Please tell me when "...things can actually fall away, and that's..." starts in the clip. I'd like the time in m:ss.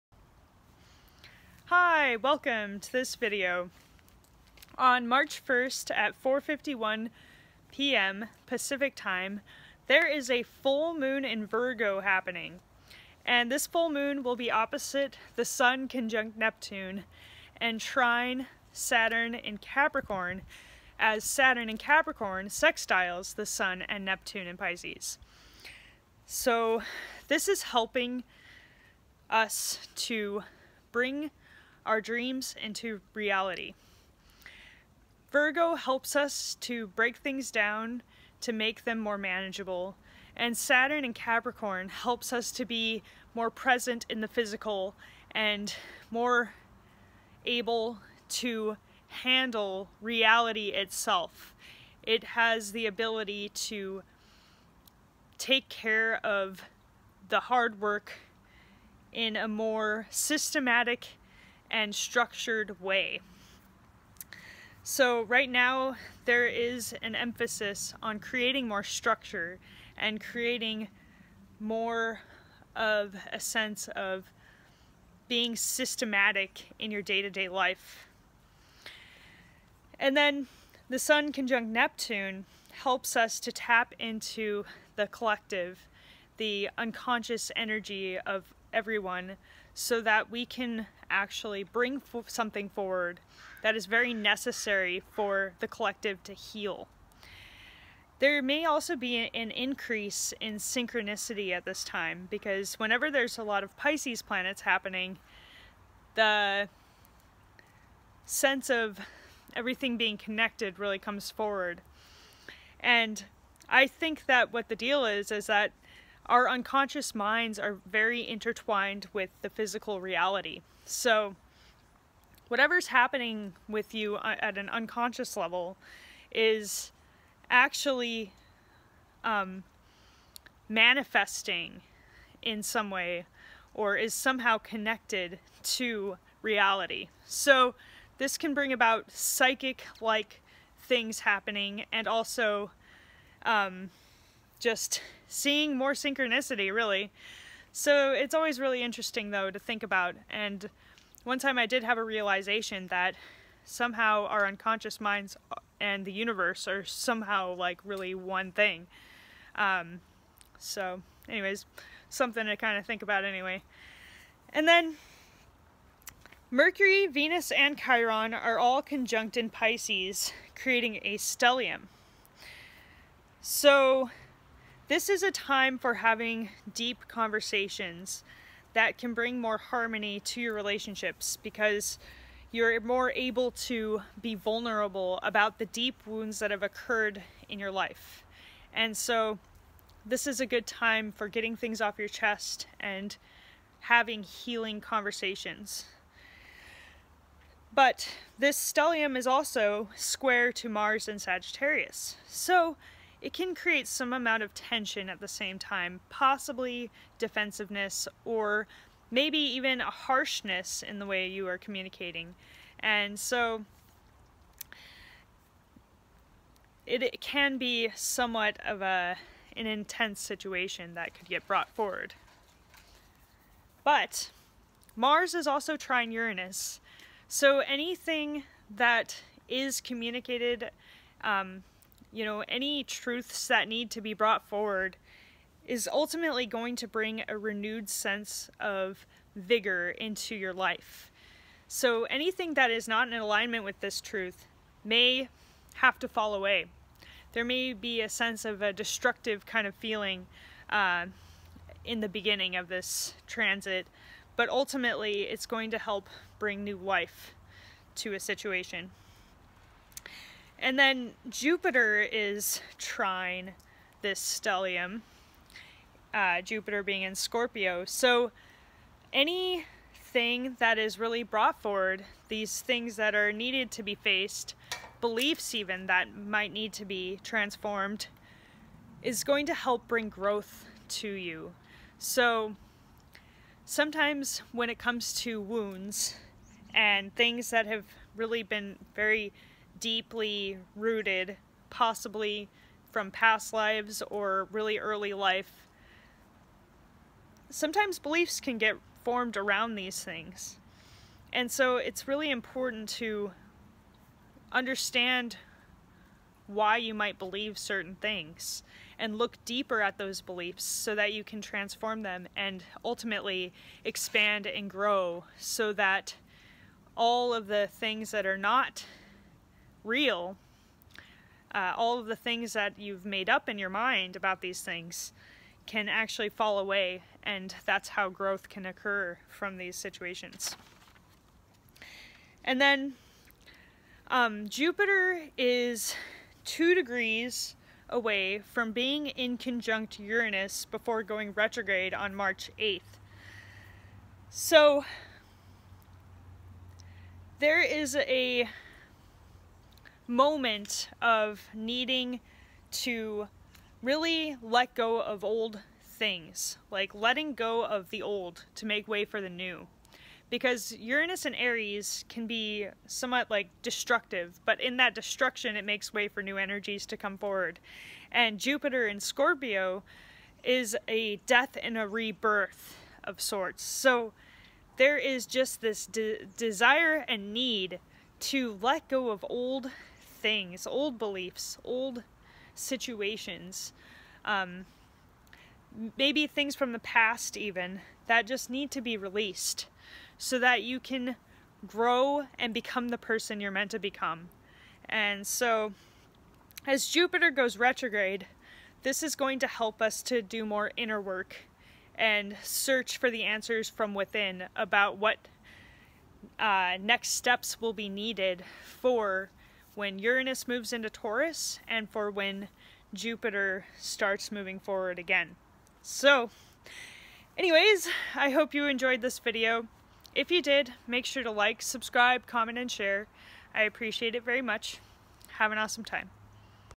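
5:24.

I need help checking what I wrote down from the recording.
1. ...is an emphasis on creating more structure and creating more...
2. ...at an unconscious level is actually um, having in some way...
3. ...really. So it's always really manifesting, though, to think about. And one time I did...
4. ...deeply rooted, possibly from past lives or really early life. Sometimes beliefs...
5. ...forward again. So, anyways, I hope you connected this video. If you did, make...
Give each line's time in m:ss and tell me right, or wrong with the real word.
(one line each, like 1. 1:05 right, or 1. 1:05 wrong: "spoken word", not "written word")
1. 1:06 right
2. 2:04 wrong: "manifesting", not "having"
3. 2:26 wrong: "interesting", not "manifesting"
4. 4:49 right
5. 6:54 wrong: "enjoyed", not "connected".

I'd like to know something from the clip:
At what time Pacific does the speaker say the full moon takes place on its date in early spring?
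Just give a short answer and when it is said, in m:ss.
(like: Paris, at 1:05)
4:51 p.m., at 0:06.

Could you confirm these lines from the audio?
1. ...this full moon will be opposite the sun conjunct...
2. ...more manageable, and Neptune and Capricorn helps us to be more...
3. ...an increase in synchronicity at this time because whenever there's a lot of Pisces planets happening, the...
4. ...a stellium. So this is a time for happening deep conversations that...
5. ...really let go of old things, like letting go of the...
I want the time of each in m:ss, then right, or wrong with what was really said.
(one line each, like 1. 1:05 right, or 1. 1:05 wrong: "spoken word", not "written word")
1. 0:13 right
2. 0:38 wrong: "Saturn", not "Neptune"
3. 1:39 right
4. 2:51 wrong: "having", not "happening"
5. 5:53 right.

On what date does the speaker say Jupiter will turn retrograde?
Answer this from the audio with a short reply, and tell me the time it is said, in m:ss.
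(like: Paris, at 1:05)
March 8, at 5:42.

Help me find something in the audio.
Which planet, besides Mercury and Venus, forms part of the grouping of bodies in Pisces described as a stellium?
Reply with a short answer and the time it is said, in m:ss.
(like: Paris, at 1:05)
Chiron, at 2:47.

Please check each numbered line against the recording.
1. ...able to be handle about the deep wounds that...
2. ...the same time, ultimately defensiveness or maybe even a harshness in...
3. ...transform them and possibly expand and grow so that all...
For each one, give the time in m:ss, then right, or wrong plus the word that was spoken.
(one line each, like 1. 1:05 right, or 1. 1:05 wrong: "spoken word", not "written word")
1. 3:03 wrong: "vulnerable", not "handle"
2. 3:25 wrong: "possibly", not "ultimately"
3. 5:11 wrong: "ultimately", not "possibly".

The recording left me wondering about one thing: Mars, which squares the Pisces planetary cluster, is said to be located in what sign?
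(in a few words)
Sagittarius.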